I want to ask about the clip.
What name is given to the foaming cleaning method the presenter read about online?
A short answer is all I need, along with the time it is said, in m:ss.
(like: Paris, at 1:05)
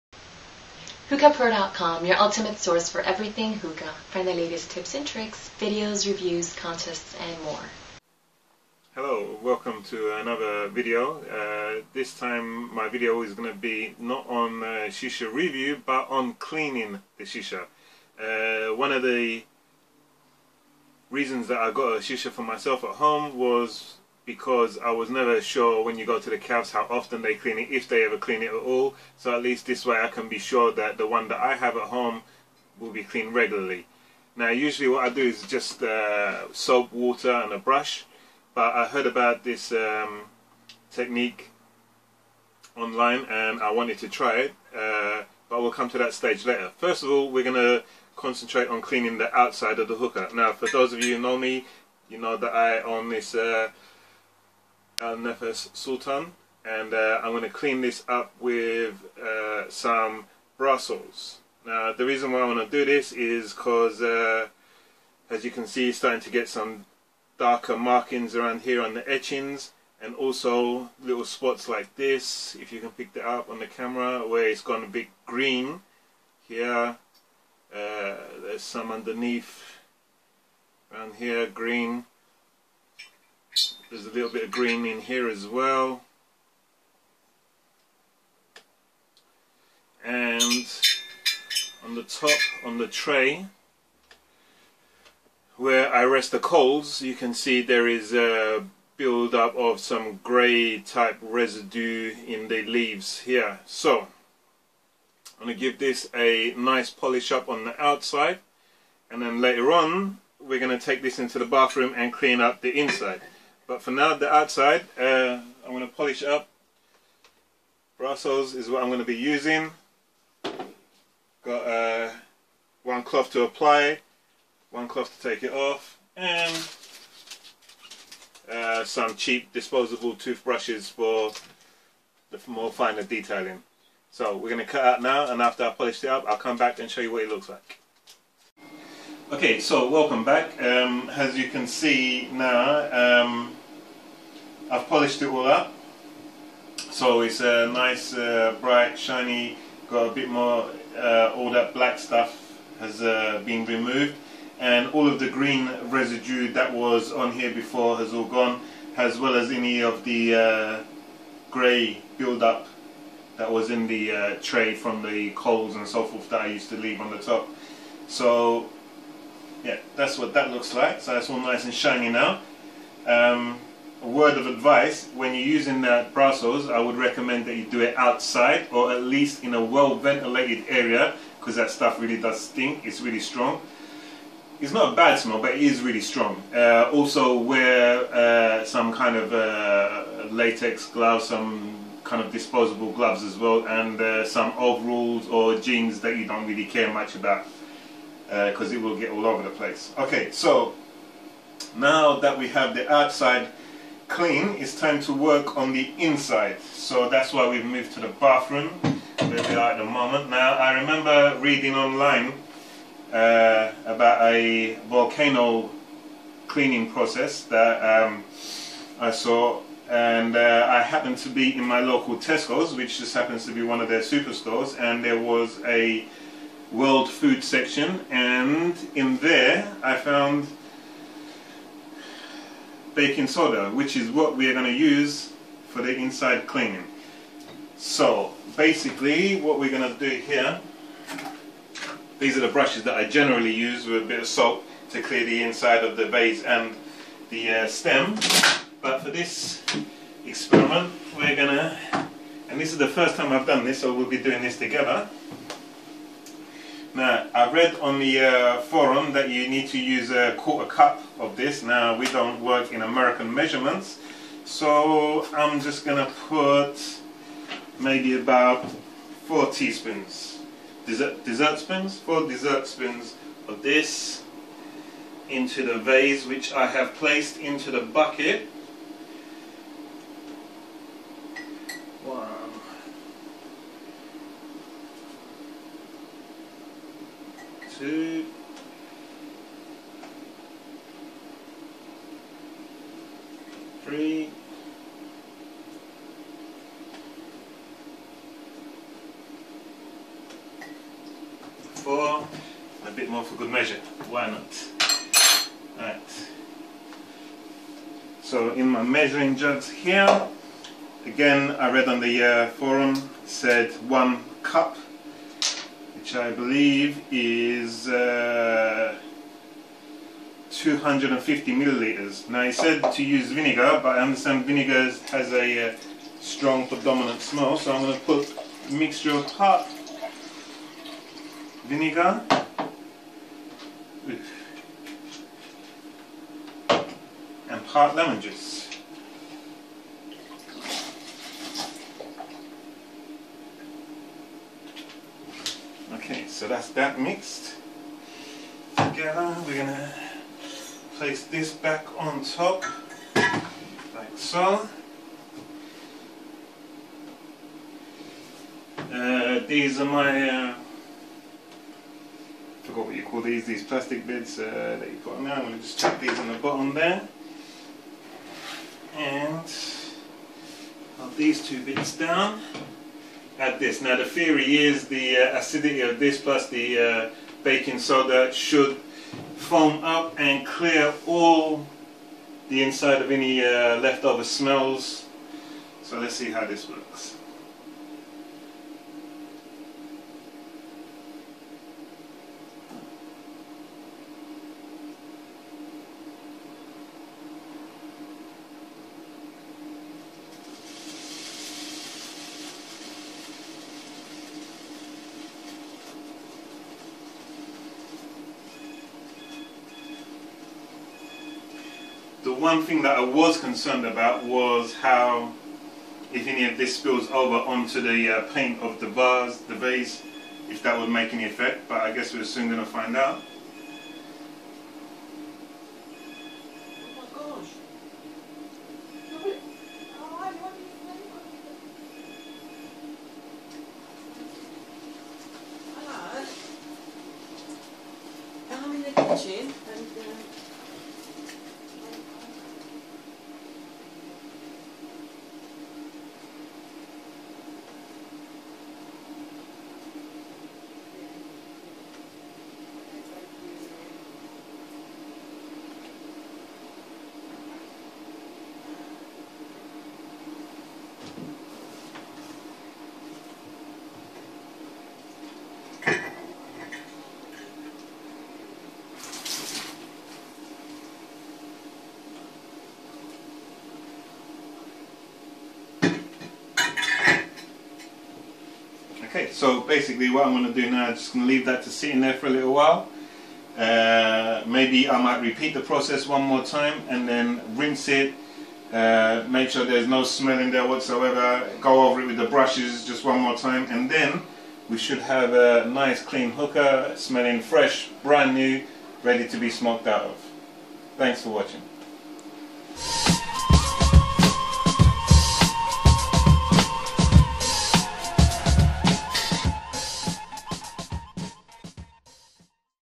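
volcano cleaning process, at 3:34.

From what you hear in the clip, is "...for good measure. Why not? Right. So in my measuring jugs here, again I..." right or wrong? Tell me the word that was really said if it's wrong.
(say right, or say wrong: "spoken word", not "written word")
right.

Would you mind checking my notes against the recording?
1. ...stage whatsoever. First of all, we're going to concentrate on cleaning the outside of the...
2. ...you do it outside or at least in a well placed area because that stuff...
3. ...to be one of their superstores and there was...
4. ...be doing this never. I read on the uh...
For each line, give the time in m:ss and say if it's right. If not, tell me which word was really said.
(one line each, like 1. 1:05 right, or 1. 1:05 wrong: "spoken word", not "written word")
1. 0:46 wrong: "later", not "whatsoever"
2. 2:57 wrong: "ventilated", not "placed"
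3. 3:43 right
4. 4:14 wrong: "together", not "never".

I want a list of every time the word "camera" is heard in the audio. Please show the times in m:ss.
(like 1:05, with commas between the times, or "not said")
1:13.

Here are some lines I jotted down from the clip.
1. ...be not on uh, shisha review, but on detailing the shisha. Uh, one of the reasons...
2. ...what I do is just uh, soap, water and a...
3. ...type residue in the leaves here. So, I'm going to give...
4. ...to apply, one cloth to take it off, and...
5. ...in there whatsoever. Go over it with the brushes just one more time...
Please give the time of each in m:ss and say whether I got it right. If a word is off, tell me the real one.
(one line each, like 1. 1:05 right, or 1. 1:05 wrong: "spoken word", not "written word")
1. 0:13 wrong: "cleaning", not "detailing"
2. 0:34 right
3. 1:40 right
4. 2:03 right
5. 8:10 right.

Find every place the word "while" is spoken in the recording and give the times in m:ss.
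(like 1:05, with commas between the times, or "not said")
8:02.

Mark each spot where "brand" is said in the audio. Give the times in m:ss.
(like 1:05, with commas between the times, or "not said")
8:18.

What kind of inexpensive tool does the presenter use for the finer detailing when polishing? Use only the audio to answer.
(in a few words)
disposable toothbrushes.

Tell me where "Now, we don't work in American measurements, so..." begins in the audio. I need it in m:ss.
4:21.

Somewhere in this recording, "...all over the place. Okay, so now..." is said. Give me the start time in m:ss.
3:19.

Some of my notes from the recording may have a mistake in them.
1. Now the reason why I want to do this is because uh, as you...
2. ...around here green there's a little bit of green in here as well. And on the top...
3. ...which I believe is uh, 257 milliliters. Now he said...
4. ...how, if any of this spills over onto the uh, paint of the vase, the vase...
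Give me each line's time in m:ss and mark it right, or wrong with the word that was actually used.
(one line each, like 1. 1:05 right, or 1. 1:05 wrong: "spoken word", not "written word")
1. 1:01 right
2. 1:20 right
3. 5:15 wrong: "250", not "257"
4. 6:54 right.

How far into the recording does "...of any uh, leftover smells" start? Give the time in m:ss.
6:23.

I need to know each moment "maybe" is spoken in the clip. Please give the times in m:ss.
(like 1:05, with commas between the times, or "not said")
4:27, 8:04.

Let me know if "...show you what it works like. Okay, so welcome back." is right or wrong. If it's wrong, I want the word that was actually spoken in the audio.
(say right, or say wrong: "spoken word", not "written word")
wrong: "looks", not "works".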